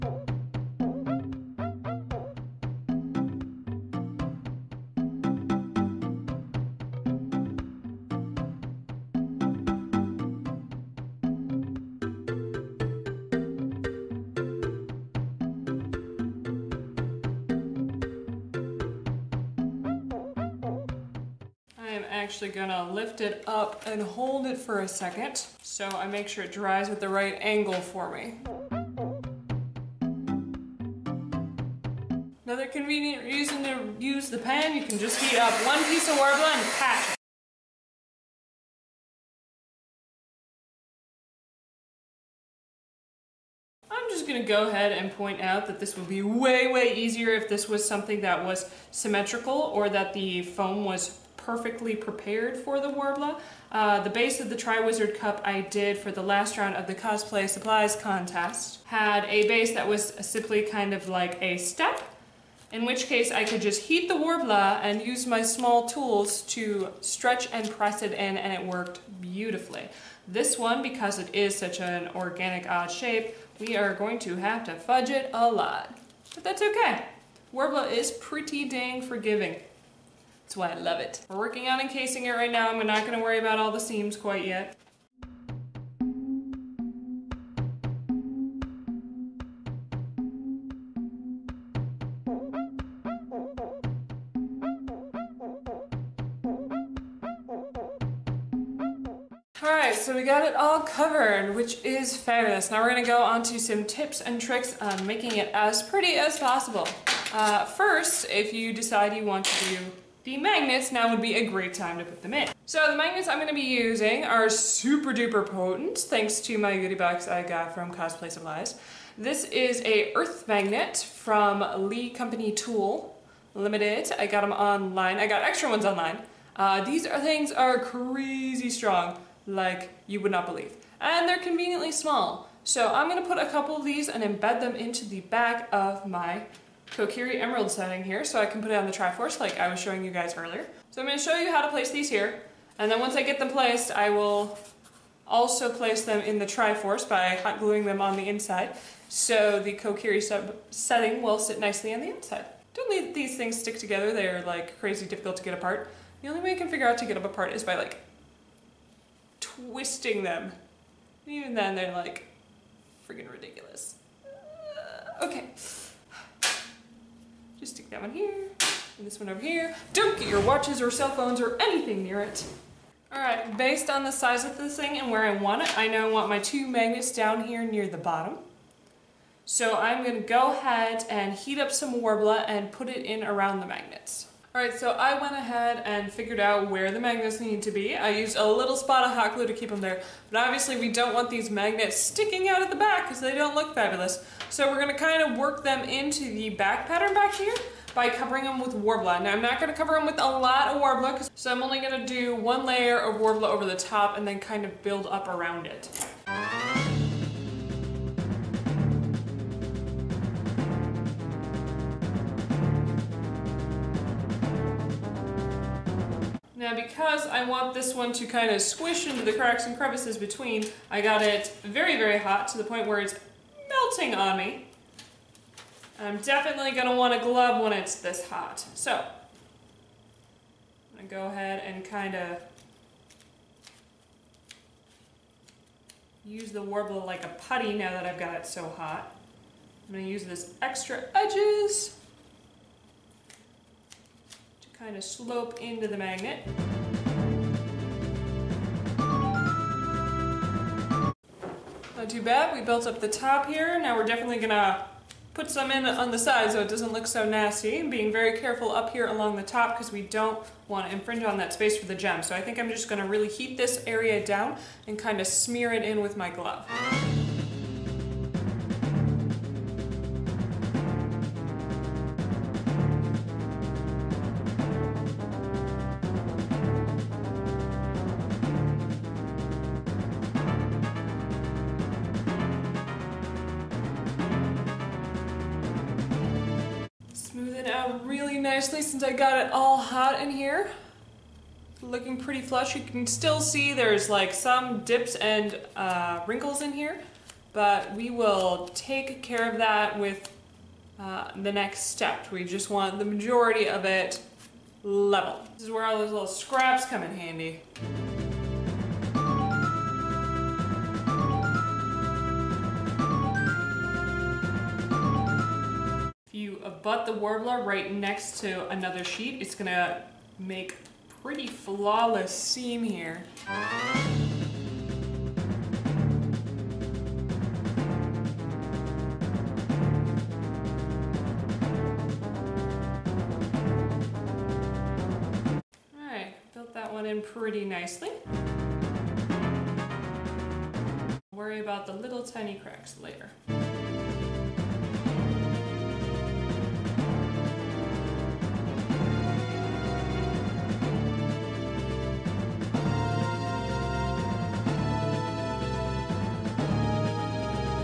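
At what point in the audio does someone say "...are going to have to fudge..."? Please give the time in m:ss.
1:13.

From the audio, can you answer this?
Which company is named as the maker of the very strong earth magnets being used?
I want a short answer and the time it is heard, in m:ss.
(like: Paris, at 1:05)
Lee Company Tool Limited, at 2:01.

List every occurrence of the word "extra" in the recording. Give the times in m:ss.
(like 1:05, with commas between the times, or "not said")
2:05, 4:00.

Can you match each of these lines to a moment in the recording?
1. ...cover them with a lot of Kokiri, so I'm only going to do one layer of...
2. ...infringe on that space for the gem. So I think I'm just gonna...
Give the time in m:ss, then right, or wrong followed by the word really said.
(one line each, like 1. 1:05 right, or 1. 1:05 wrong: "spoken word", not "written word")
1. 3:19 wrong: "Worbla", not "Kokiri"
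2. 4:20 right.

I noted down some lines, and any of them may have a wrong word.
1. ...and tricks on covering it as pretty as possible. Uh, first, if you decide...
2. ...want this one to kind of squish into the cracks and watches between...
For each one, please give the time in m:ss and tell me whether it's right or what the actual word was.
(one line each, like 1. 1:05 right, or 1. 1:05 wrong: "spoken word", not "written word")
1. 1:44 wrong: "making", not "covering"
2. 3:37 wrong: "crevices", not "watches".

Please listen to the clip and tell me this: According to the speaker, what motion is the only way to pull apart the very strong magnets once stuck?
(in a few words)
Twisting them.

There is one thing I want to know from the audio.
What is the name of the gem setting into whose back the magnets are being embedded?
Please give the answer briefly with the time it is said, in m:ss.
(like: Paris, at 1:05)
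Kokiri Emerald, at 2:16.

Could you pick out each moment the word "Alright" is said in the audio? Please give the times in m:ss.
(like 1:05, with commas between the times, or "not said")
1:39, 3:04, 5:35.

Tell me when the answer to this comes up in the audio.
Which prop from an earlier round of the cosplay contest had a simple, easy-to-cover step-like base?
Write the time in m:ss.
0:54.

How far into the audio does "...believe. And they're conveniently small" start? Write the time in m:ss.
2:10.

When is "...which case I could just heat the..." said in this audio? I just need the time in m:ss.
1:02.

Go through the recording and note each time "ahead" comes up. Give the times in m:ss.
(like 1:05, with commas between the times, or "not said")
0:44, 3:00, 3:05, 3:51.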